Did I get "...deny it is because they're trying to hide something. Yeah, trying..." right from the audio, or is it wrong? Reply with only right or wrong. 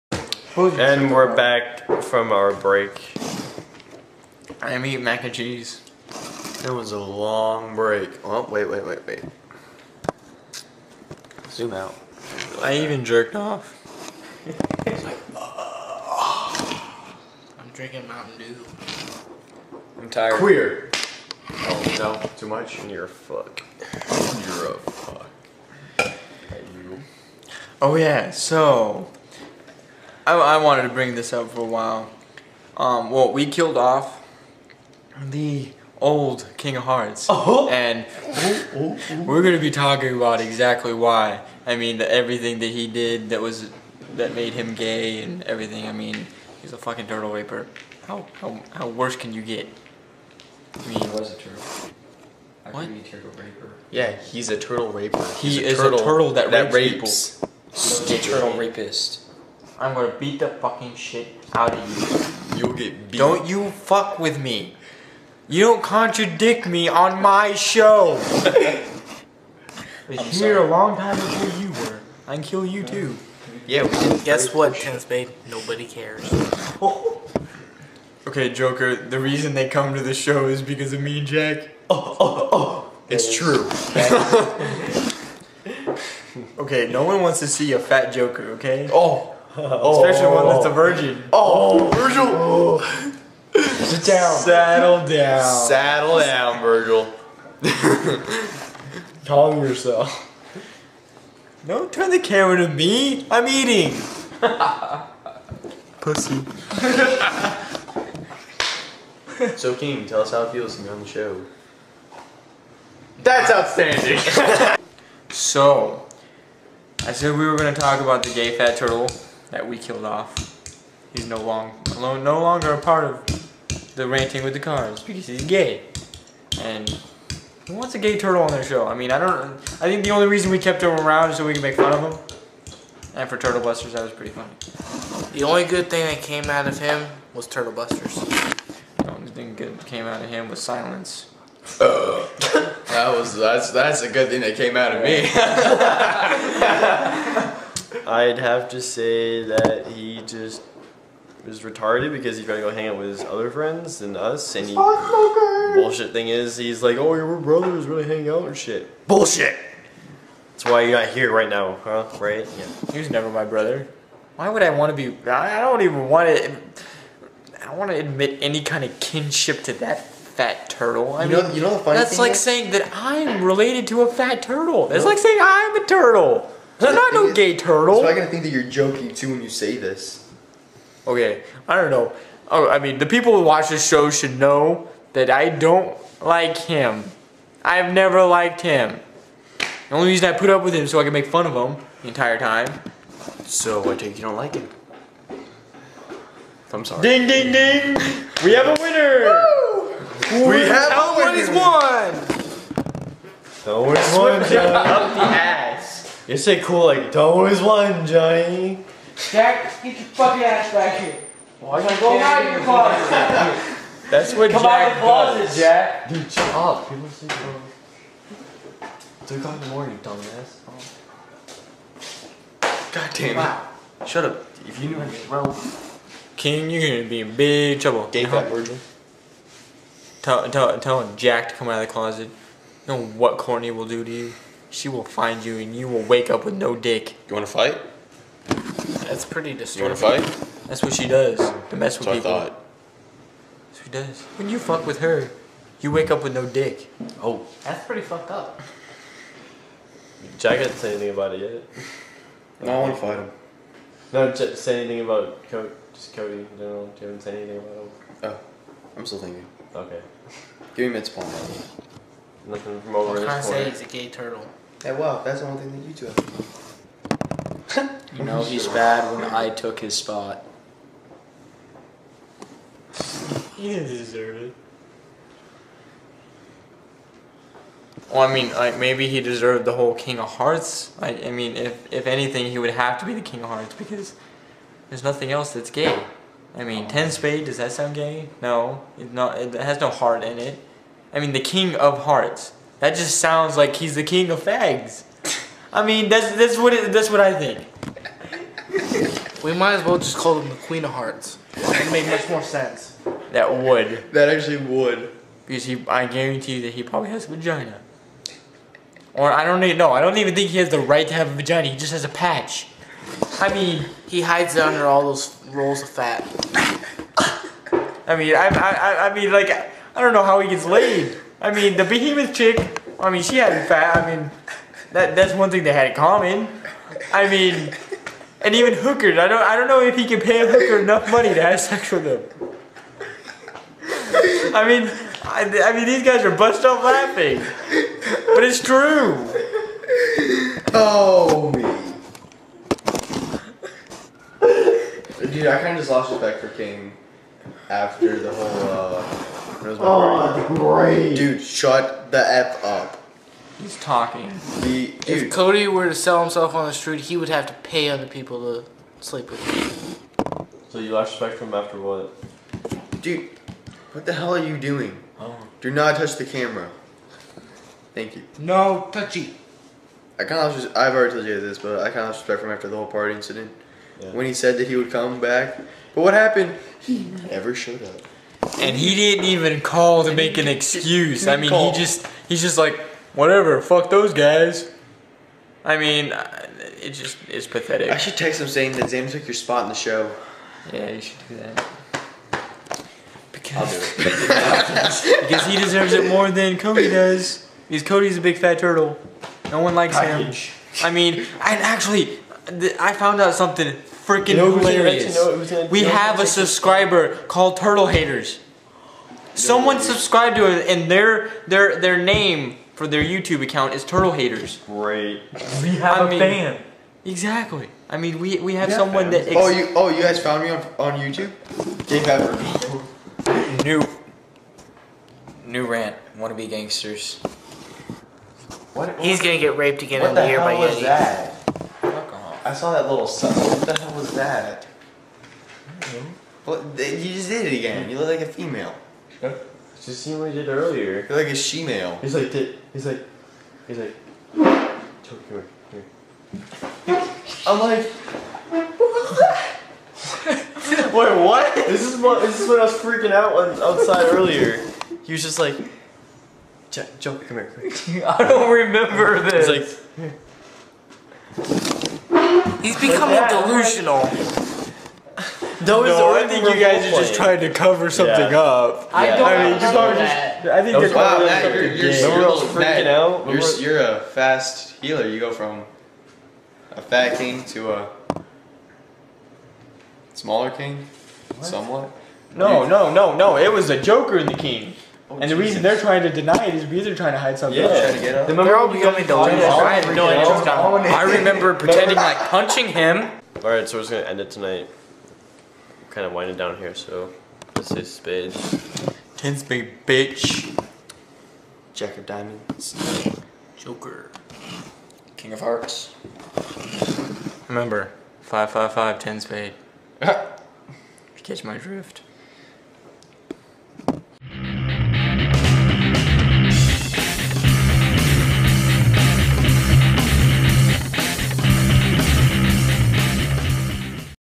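right.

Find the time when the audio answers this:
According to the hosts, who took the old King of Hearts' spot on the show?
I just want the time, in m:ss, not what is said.
6:28.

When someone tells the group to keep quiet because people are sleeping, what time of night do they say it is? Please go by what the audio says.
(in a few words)
3 o'clock.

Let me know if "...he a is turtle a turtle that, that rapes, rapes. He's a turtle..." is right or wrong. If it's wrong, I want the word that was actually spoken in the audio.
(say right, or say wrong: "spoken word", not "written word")
right.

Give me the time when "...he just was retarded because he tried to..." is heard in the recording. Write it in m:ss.
2:29.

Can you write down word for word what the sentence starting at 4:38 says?
Well, I mean, like maybe he deserved the whole King of Hearts.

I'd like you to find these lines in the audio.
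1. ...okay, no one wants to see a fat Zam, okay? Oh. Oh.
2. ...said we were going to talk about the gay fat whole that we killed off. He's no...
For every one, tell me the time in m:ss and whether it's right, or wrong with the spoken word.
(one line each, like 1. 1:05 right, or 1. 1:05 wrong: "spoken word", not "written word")
1. 1:26 wrong: "Joker", not "Zam"
2. 1:57 wrong: "turtle", not "whole".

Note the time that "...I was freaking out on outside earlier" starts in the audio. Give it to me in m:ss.
7:32.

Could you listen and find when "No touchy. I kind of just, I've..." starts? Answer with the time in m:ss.
6:08.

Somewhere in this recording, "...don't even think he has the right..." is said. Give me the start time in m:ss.
5:10.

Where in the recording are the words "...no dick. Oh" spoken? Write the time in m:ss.
4:06.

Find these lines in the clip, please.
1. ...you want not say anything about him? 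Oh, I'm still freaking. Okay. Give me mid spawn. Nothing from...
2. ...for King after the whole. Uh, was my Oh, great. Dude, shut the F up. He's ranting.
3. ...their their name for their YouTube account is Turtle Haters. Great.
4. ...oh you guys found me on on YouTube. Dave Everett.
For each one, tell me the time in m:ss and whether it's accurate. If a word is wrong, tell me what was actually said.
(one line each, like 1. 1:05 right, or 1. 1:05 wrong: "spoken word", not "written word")
1. 4:17 wrong: "thinking", not "freaking"
2. 5:46 wrong: "talking", not "ranting"
3. 6:51 right
4. 6:59 right.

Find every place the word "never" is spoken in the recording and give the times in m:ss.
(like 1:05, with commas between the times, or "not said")
2:43, 3:07, 6:17.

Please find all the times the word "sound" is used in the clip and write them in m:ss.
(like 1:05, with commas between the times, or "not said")
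4:47, 4:53.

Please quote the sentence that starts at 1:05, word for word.
You don't contradict me on my show.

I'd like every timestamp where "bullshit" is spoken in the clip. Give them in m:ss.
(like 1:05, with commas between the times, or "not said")
2:34, 2:39.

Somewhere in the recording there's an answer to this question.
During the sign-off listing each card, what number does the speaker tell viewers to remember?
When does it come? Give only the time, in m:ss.
8:28.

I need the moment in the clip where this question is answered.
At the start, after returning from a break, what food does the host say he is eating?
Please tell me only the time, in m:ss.
0:05.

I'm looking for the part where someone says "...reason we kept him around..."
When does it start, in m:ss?
2:10.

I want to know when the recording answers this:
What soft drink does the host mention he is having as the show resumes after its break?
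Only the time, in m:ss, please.
0:18.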